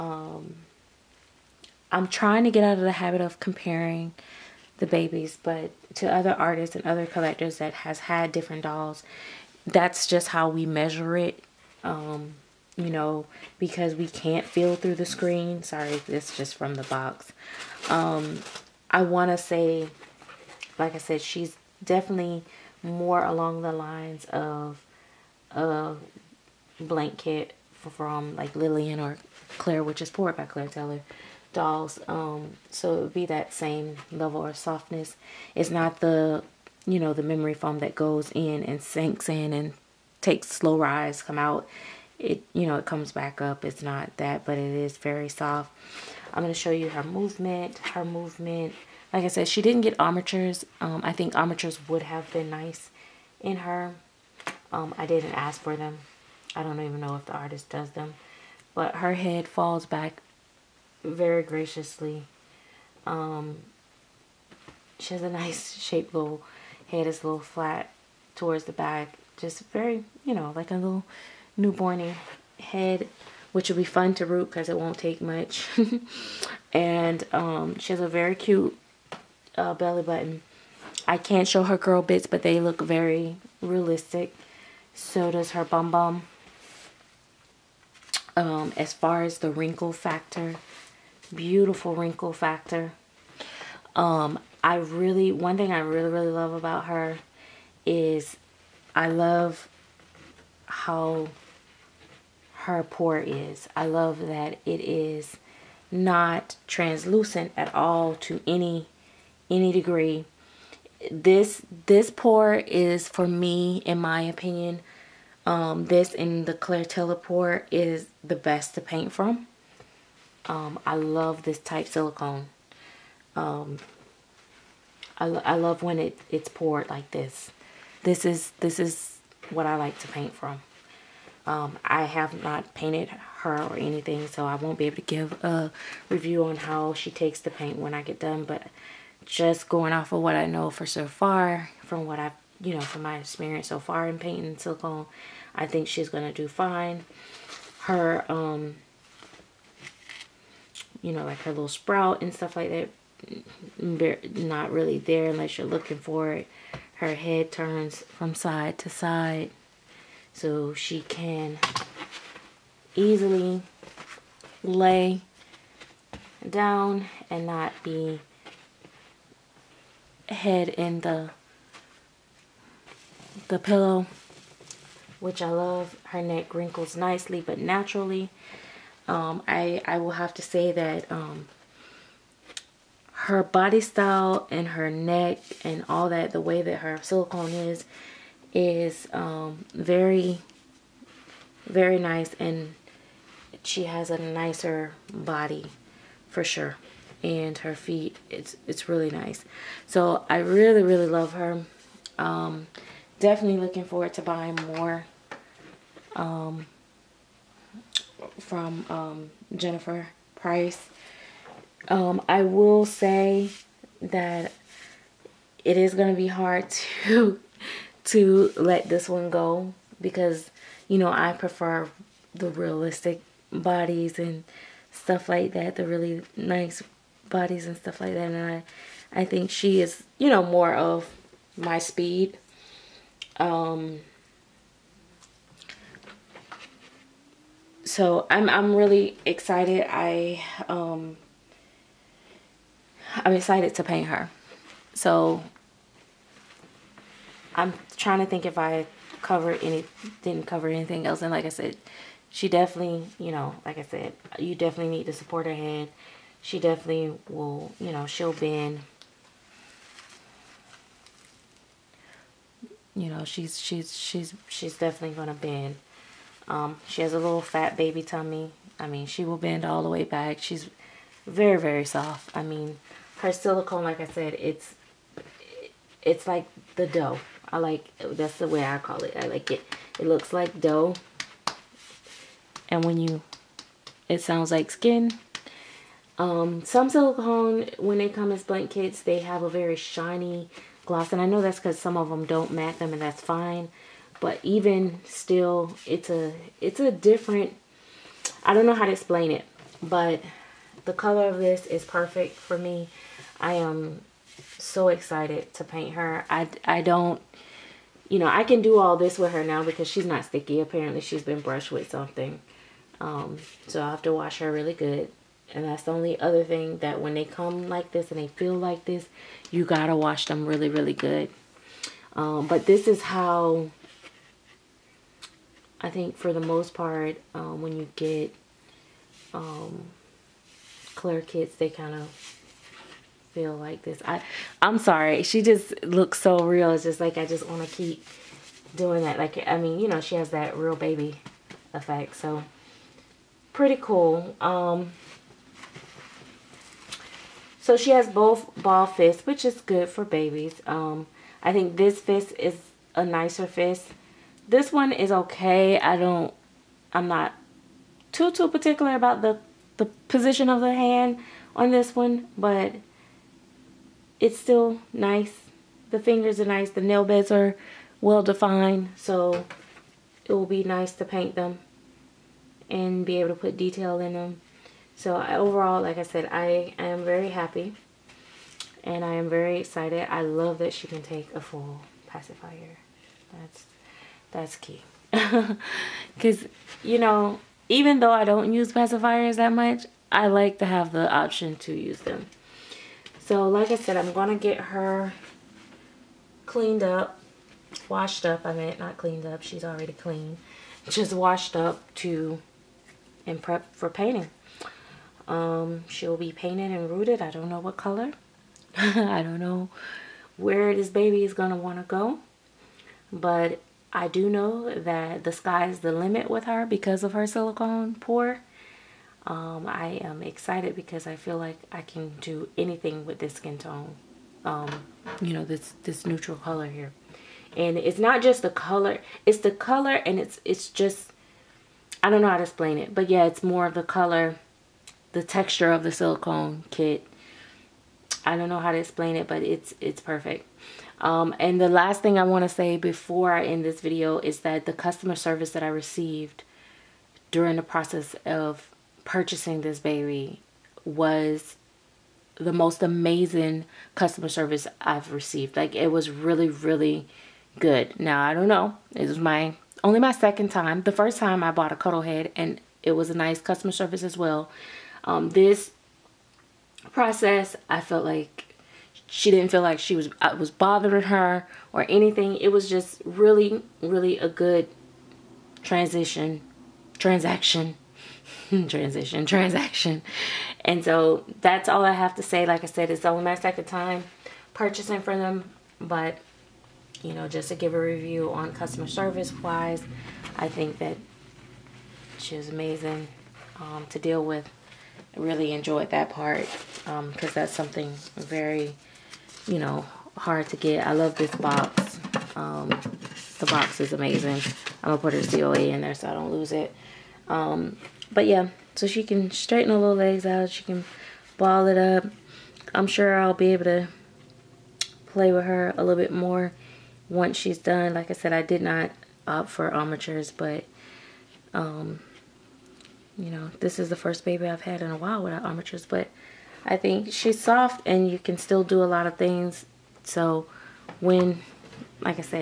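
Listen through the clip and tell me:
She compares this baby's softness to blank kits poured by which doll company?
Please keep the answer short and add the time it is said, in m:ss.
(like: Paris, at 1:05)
Claire Taylor dolls, at 0:30.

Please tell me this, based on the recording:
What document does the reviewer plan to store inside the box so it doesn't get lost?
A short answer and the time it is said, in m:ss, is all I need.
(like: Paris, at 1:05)
COA, at 8:25.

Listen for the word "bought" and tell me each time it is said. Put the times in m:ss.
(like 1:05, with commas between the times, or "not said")
7:41.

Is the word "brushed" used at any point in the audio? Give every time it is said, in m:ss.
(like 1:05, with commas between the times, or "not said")
5:11.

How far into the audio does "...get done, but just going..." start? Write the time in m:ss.
2:18.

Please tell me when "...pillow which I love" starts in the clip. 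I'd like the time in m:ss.
2:53.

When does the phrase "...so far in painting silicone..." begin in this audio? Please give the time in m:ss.
2:23.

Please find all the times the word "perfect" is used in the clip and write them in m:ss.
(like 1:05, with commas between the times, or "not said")
5:01, 7:20.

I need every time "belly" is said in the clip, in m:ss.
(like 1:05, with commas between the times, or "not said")
1:19.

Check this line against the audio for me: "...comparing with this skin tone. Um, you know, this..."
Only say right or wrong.
wrong.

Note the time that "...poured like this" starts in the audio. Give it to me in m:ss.
2:06.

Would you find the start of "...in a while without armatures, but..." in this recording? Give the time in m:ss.
8:44.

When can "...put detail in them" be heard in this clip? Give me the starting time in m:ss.
6:13.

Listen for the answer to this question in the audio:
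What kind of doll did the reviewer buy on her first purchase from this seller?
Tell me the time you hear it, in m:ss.
7:41.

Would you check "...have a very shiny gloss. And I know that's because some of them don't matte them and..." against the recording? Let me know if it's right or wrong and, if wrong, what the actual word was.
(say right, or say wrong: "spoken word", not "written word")
right.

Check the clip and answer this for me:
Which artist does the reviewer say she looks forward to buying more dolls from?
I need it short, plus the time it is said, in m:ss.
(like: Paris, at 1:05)
Jennifer Price, at 3:29.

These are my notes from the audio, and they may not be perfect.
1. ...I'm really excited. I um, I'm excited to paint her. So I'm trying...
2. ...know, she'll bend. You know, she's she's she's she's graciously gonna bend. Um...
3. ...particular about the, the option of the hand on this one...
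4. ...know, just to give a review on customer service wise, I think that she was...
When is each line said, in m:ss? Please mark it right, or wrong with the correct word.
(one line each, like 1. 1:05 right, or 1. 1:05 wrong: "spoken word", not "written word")
1. 3:58 right
2. 4:17 wrong: "definitely", not "graciously"
3. 5:58 wrong: "position", not "option"
4. 8:07 right.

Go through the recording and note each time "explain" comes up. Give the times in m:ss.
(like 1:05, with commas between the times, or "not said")
4:58, 7:12, 7:18.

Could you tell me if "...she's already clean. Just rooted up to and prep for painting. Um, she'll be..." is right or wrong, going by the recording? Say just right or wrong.
wrong.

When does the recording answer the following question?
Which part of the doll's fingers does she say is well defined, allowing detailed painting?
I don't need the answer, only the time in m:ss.
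6:06.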